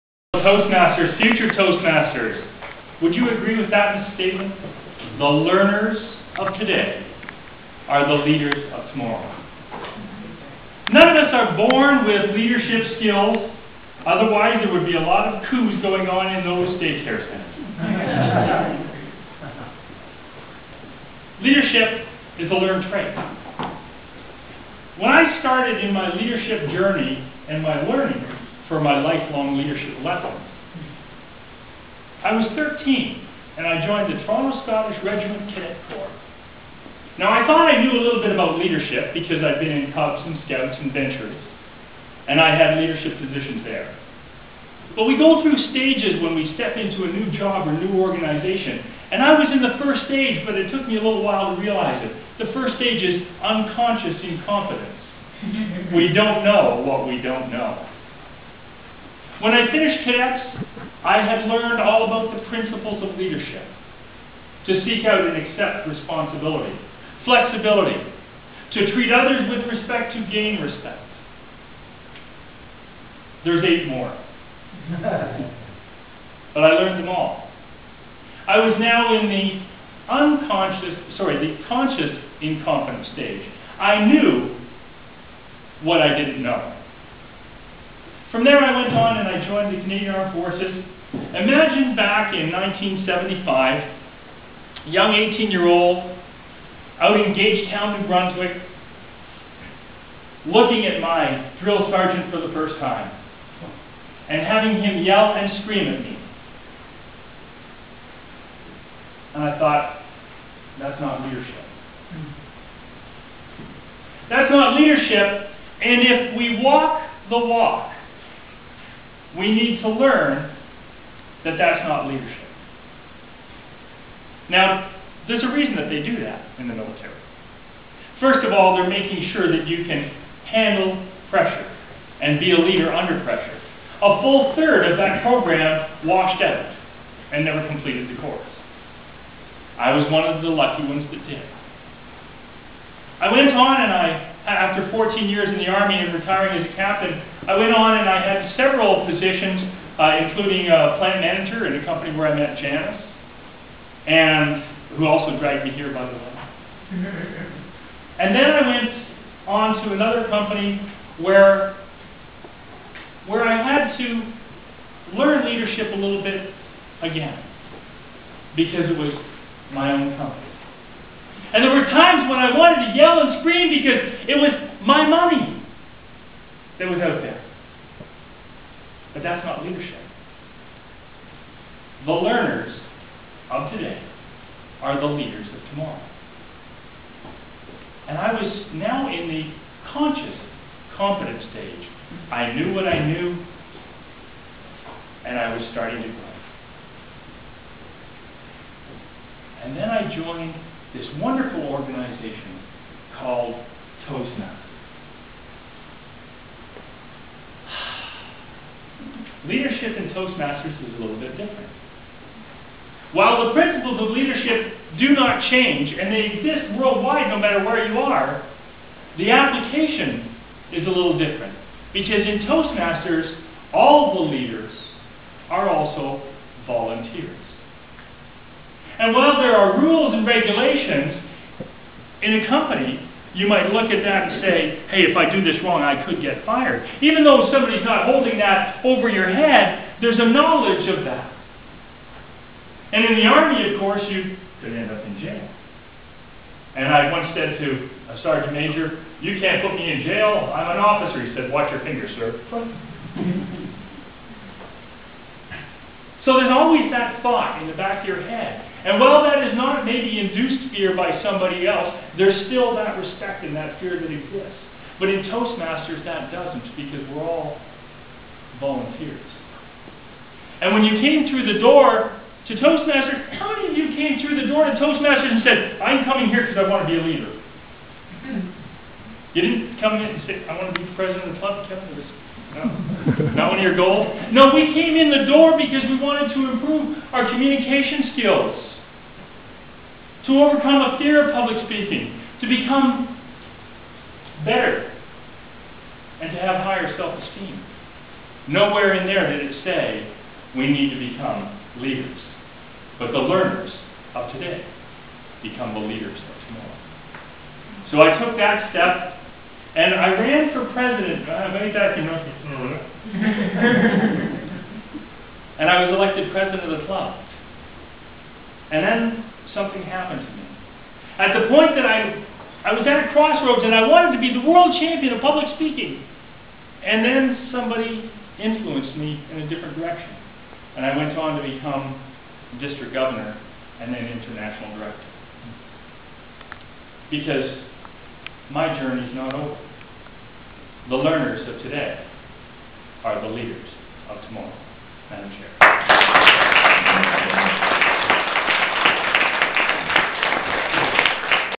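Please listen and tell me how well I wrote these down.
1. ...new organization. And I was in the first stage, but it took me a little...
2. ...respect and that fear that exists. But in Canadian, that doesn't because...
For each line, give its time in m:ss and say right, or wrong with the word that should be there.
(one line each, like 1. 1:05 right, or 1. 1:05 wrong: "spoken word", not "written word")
1. 0:47 right
2. 4:22 wrong: "Toastmasters", not "Canadian".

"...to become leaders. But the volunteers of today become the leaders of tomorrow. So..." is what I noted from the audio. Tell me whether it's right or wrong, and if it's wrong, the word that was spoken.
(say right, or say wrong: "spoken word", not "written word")
wrong: "learners", not "volunteers".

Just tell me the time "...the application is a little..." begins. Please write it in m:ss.
3:39.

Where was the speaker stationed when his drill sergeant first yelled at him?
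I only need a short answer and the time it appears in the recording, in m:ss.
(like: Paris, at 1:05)
Gagetown, New Brunswick, at 1:37.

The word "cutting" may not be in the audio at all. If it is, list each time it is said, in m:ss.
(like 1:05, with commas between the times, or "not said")
not said.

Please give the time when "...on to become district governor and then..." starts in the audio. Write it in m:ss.
5:31.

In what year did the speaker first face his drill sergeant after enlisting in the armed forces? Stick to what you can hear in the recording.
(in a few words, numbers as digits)
1975.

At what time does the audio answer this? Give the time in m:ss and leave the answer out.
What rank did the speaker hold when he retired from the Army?
2:26.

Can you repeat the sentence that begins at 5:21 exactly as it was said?
At the point that I, I was at a crossroads and I wanted to be the world champion of public speaking.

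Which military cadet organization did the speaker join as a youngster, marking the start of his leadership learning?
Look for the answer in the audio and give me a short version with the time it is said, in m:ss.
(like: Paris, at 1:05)
Toronto Scottish Regiment Cadet Corps, at 0:34.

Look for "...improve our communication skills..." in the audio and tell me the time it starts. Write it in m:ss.
4:46.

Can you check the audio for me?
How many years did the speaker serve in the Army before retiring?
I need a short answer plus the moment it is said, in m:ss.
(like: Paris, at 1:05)
14, at 2:24.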